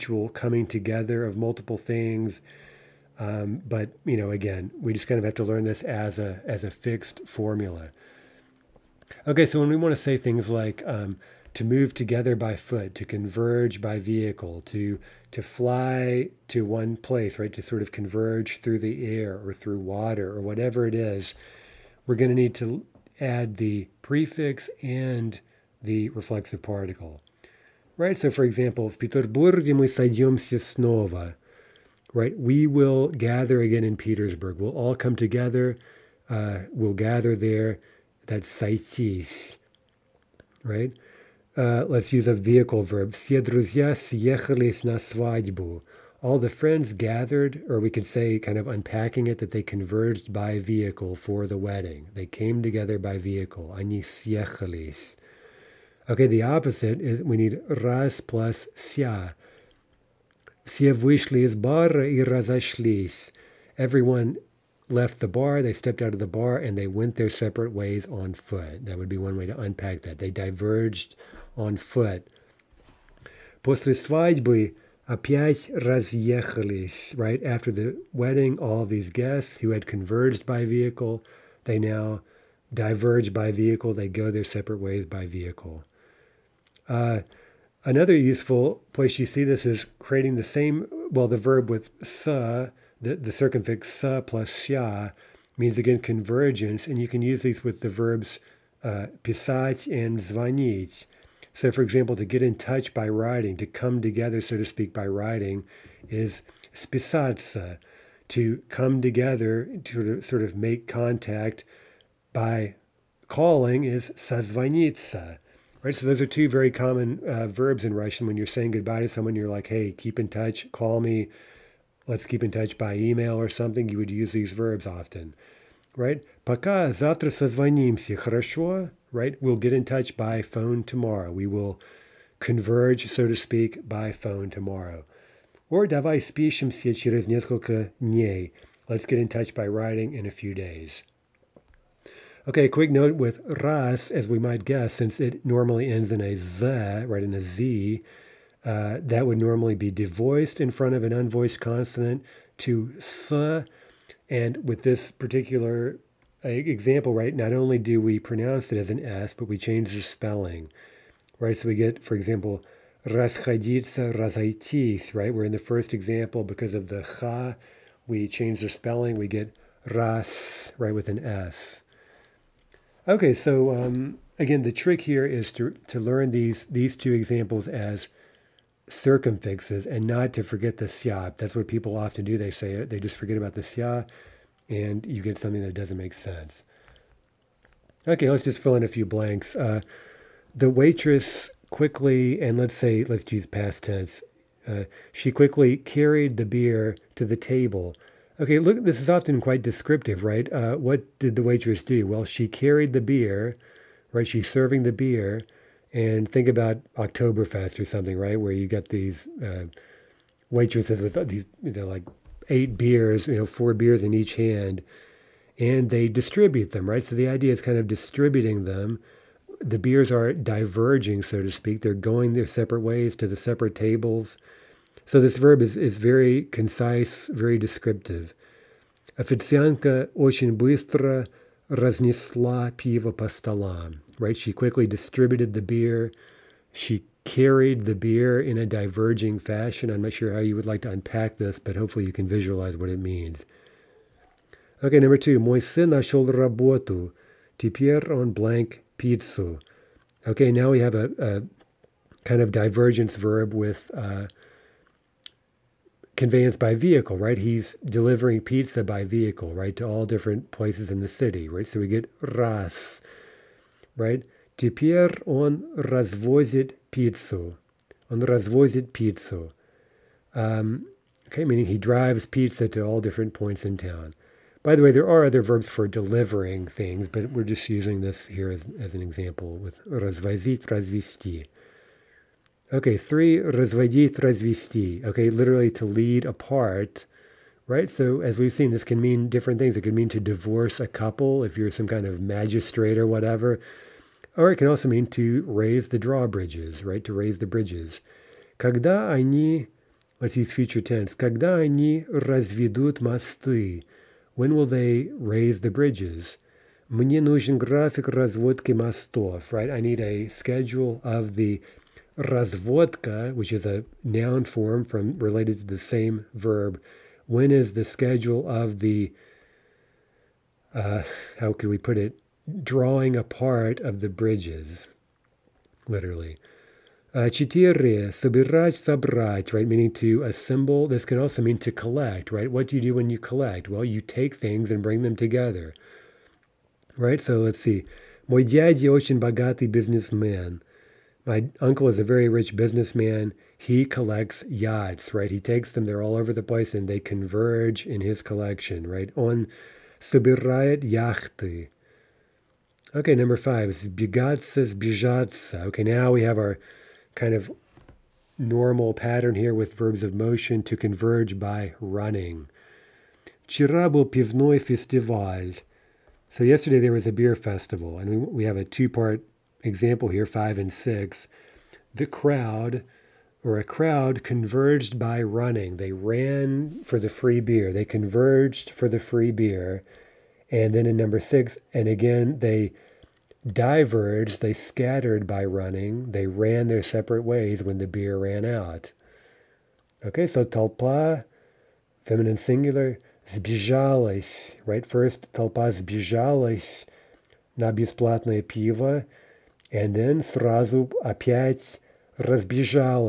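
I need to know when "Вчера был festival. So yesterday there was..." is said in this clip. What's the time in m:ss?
6:03.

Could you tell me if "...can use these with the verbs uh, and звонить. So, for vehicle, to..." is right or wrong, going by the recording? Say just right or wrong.
wrong.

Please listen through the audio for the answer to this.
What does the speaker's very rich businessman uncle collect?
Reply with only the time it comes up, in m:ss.
5:44.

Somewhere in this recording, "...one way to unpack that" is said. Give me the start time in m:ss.
1:09.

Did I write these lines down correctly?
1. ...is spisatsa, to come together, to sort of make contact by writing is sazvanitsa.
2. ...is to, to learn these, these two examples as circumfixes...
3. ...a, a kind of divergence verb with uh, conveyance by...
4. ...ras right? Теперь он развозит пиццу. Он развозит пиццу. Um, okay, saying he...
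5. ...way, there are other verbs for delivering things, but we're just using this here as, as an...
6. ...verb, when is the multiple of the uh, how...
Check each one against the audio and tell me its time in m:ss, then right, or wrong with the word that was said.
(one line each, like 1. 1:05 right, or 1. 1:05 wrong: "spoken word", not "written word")
1. 1:46 wrong: "calling", not "writing"
2. 2:55 right
3. 4:10 right
4. 4:22 wrong: "meaning", not "saying"
5. 4:34 right
6. 5:16 wrong: "schedule", not "multiple".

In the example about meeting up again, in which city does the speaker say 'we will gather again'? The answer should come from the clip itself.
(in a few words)
Petersburg.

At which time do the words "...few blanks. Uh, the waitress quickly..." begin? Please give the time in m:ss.
3:08.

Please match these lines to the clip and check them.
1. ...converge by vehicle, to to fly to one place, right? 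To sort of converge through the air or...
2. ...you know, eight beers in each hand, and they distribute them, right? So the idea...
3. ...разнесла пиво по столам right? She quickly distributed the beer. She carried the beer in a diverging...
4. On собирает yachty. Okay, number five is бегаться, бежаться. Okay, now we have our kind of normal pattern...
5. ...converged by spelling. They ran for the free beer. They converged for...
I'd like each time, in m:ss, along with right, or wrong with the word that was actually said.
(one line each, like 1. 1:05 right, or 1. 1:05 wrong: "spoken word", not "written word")
1. 0:13 right
2. 3:33 wrong: "four", not "eight"
3. 3:51 right
4. 5:49 right
5. 6:14 wrong: "running", not "spelling".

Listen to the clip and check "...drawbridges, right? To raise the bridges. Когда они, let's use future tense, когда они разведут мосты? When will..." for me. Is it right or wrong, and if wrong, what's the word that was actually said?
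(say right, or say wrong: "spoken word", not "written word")
right.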